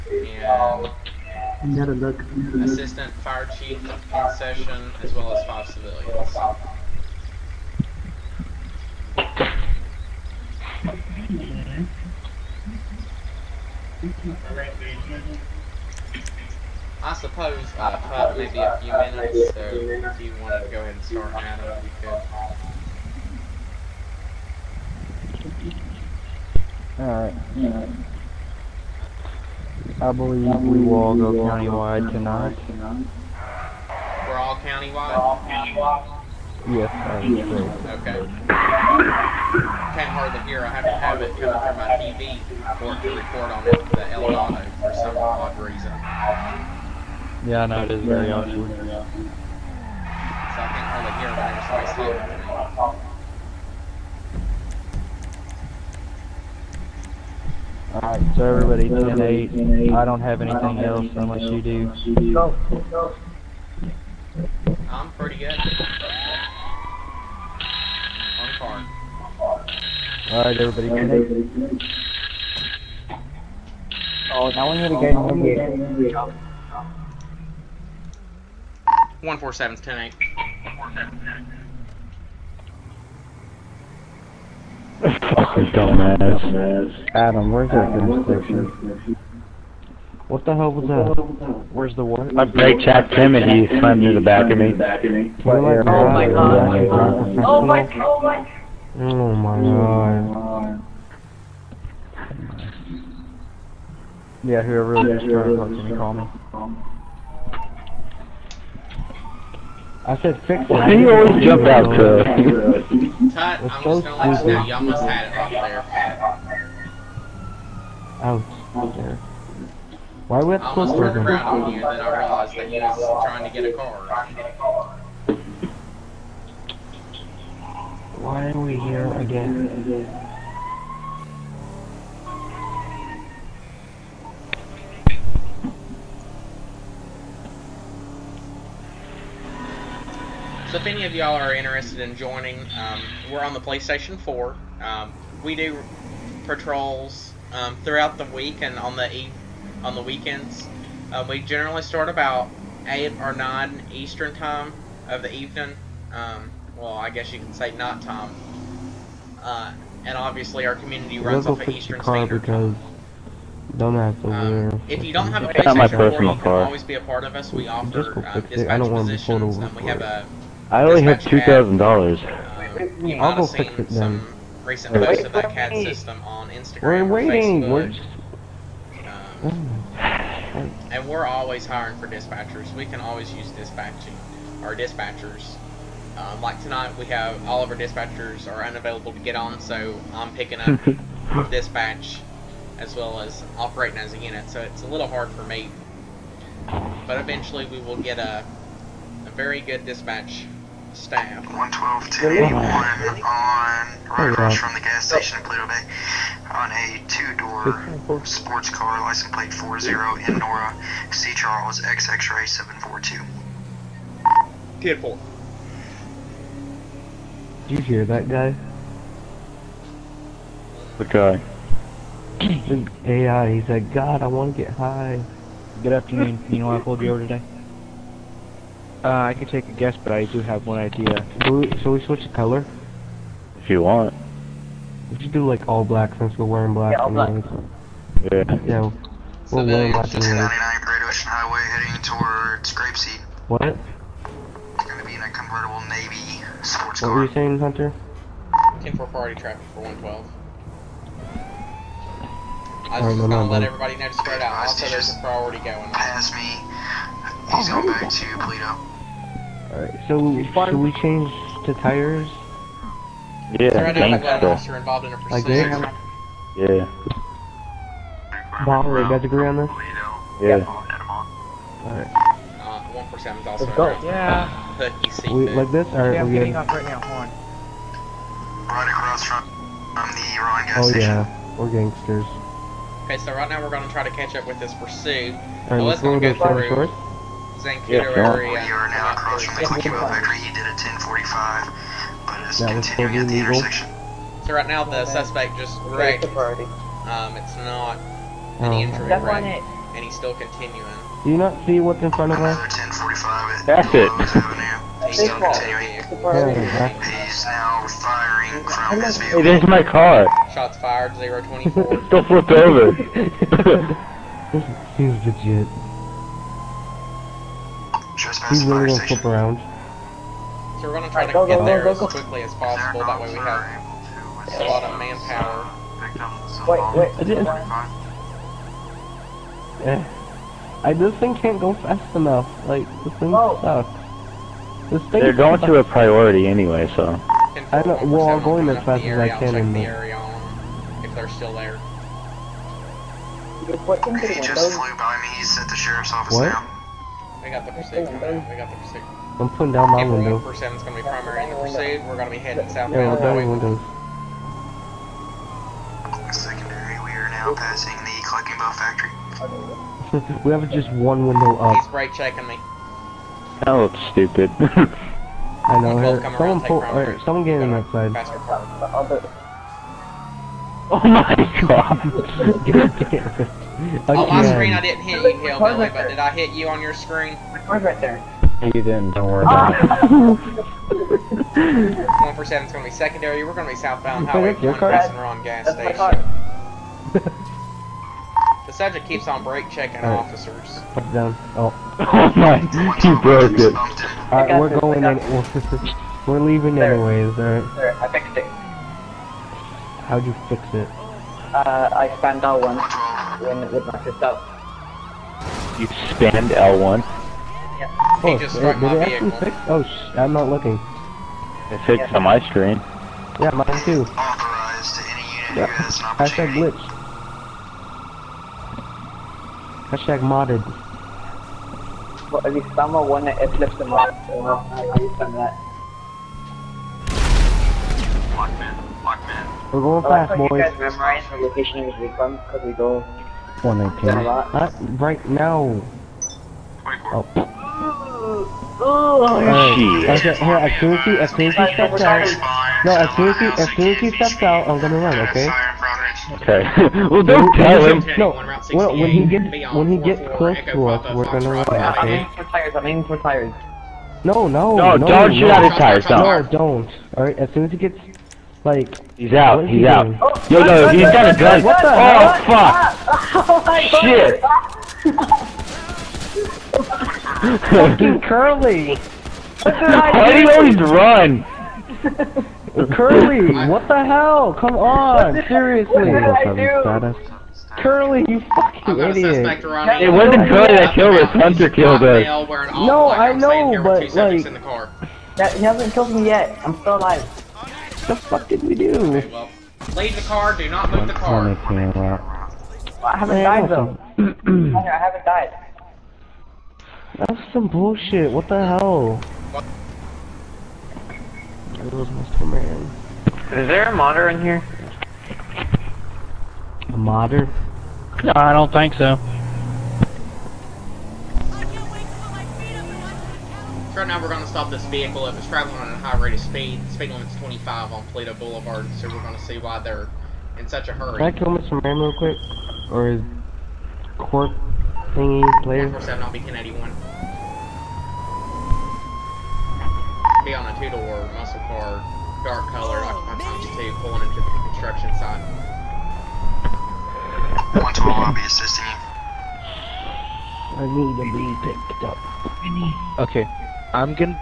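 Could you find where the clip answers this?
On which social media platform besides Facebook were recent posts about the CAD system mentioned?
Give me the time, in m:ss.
2:56.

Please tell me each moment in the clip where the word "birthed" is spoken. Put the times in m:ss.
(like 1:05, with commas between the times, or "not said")
not said.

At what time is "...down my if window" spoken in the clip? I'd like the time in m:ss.
5:49.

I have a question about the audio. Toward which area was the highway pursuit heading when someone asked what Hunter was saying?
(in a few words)
Grapeseed.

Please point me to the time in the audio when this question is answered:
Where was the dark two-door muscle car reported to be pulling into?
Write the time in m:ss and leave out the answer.
8:54.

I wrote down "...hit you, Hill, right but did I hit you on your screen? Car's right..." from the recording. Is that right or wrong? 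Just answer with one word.
right.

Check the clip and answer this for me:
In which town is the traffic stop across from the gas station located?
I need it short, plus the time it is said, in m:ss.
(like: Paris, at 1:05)
Paleto Bay, at 3:25.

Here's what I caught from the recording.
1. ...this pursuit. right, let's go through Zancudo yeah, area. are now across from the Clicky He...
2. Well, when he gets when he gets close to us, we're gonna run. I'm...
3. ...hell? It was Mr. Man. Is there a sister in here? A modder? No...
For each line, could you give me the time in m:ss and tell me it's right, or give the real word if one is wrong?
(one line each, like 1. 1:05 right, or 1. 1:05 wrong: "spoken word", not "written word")
1. 4:44 right
2. 7:28 right
3. 8:18 wrong: "modder", not "sister".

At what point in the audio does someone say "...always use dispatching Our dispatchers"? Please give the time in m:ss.
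3:03.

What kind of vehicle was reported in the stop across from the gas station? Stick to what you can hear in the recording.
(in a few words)
two-door sports car.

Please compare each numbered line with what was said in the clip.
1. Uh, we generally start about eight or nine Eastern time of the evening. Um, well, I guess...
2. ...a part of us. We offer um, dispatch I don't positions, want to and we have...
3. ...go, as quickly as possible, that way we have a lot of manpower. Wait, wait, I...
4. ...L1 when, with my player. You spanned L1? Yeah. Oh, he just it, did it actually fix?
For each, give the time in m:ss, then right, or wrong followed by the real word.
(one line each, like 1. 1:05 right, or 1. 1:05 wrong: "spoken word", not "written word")
1. 2:31 right
2. 2:46 right
3. 5:21 right
4. 6:42 wrong: "sister", not "player".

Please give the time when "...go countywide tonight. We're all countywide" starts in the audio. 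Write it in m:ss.
0:31.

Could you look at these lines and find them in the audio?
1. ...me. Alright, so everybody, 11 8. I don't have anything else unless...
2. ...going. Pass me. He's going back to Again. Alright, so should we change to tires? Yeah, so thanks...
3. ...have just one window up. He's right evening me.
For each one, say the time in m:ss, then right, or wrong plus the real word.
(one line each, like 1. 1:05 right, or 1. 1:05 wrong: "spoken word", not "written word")
1. 0:52 wrong: "10", not "11"
2. 4:15 wrong: "Paleto", not "Again"
3. 6:00 wrong: "checking", not "evening".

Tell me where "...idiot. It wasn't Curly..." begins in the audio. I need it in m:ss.
7:58.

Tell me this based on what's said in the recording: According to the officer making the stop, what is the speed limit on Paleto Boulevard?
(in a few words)
25.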